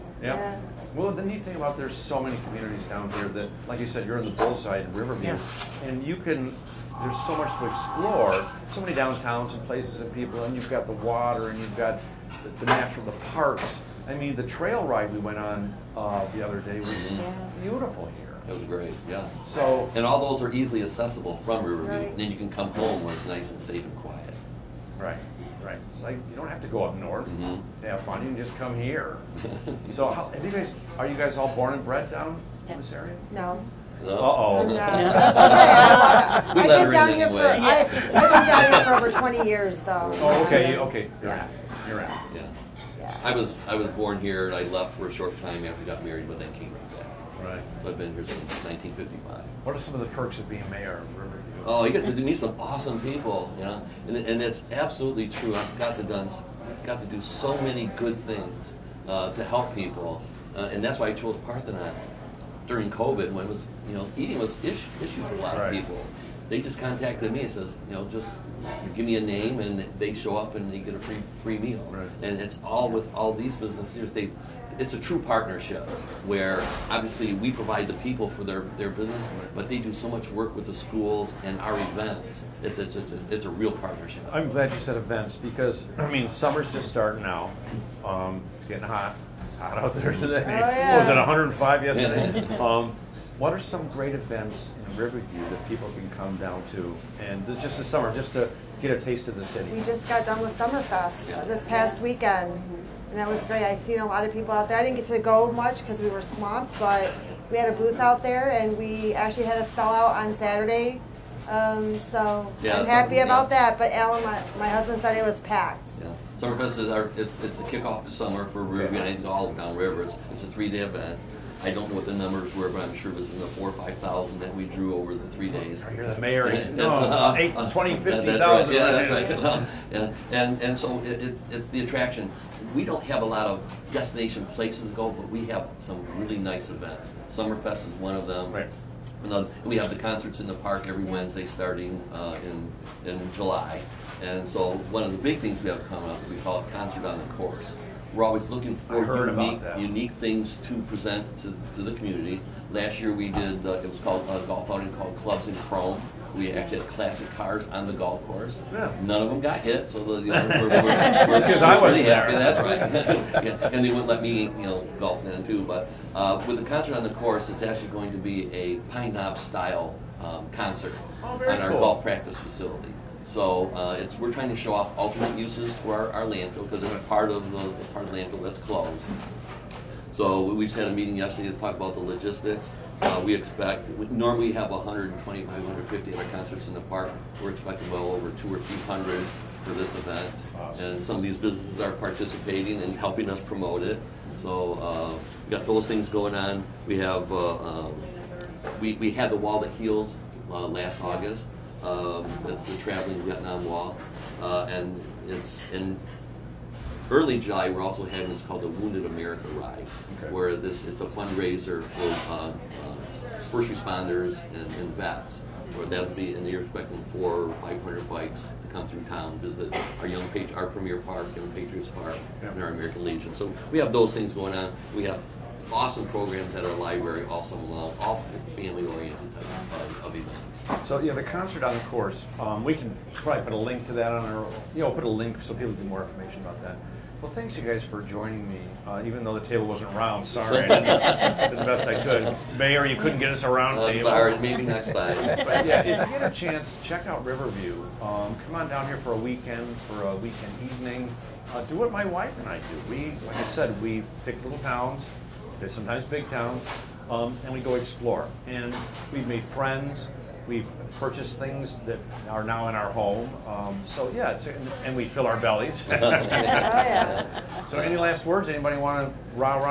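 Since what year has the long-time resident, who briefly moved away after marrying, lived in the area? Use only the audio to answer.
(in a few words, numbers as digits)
1955.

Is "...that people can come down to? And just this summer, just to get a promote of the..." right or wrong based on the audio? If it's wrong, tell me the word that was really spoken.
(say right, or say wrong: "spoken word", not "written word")
wrong: "taste", not "promote".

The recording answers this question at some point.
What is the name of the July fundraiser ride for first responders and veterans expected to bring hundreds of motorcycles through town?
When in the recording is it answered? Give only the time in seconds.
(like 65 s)
208 s.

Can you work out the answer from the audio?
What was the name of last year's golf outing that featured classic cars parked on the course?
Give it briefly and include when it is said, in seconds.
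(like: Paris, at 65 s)
Clubs in Chrome, at 155 s.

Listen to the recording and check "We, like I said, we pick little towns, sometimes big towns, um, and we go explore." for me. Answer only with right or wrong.
right.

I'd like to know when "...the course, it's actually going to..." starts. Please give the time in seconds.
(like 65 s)
167 s.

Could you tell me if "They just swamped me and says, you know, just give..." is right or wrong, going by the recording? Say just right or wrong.
wrong.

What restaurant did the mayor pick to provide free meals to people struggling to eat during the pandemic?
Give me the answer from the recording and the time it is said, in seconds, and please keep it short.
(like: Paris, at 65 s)
Parthenon, at 61 s.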